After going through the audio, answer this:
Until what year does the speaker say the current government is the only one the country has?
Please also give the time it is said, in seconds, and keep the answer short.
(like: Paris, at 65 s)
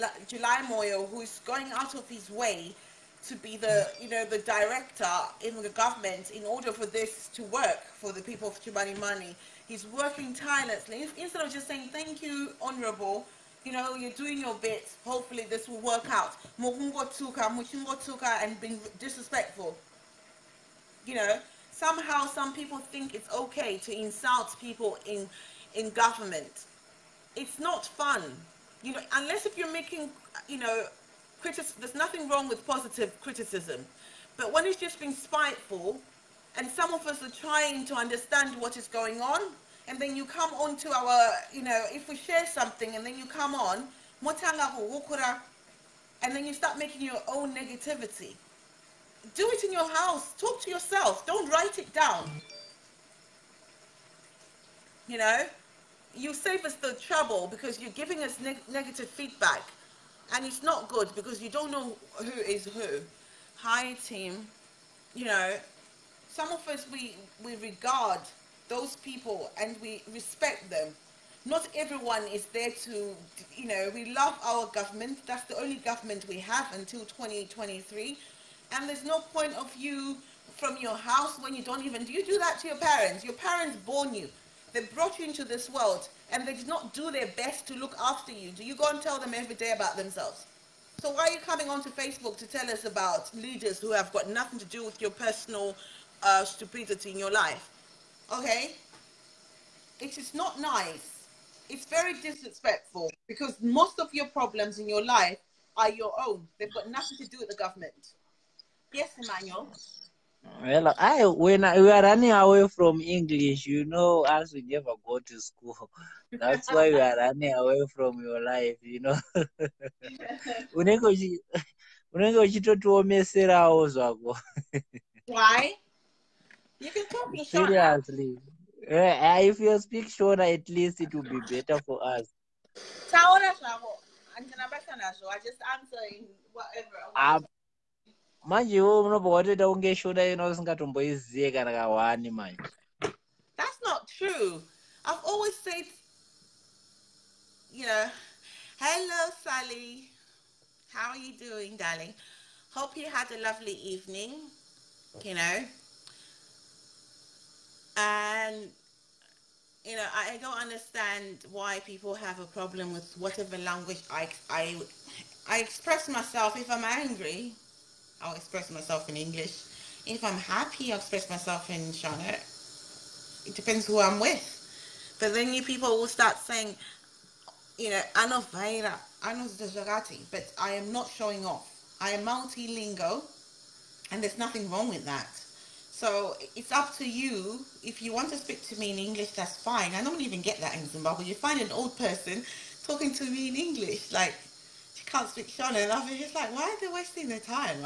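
2023, at 77 s.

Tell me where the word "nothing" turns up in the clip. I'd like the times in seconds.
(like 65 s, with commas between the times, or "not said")
32 s, 94 s, 106 s, 184 s.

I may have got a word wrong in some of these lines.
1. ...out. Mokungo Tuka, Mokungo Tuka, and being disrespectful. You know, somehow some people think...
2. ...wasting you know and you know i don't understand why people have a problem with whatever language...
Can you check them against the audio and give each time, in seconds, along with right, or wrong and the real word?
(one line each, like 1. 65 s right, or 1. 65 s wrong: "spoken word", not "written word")
1. 16 s right
2. 153 s wrong: "evening", not "wasting".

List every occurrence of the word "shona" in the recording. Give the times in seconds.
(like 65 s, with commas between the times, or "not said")
130 s, 171 s, 195 s.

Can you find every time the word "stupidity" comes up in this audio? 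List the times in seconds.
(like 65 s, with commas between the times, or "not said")
96 s.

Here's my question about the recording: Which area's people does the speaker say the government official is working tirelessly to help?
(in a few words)
Chimanimani.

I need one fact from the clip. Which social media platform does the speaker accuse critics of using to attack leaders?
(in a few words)
Facebook.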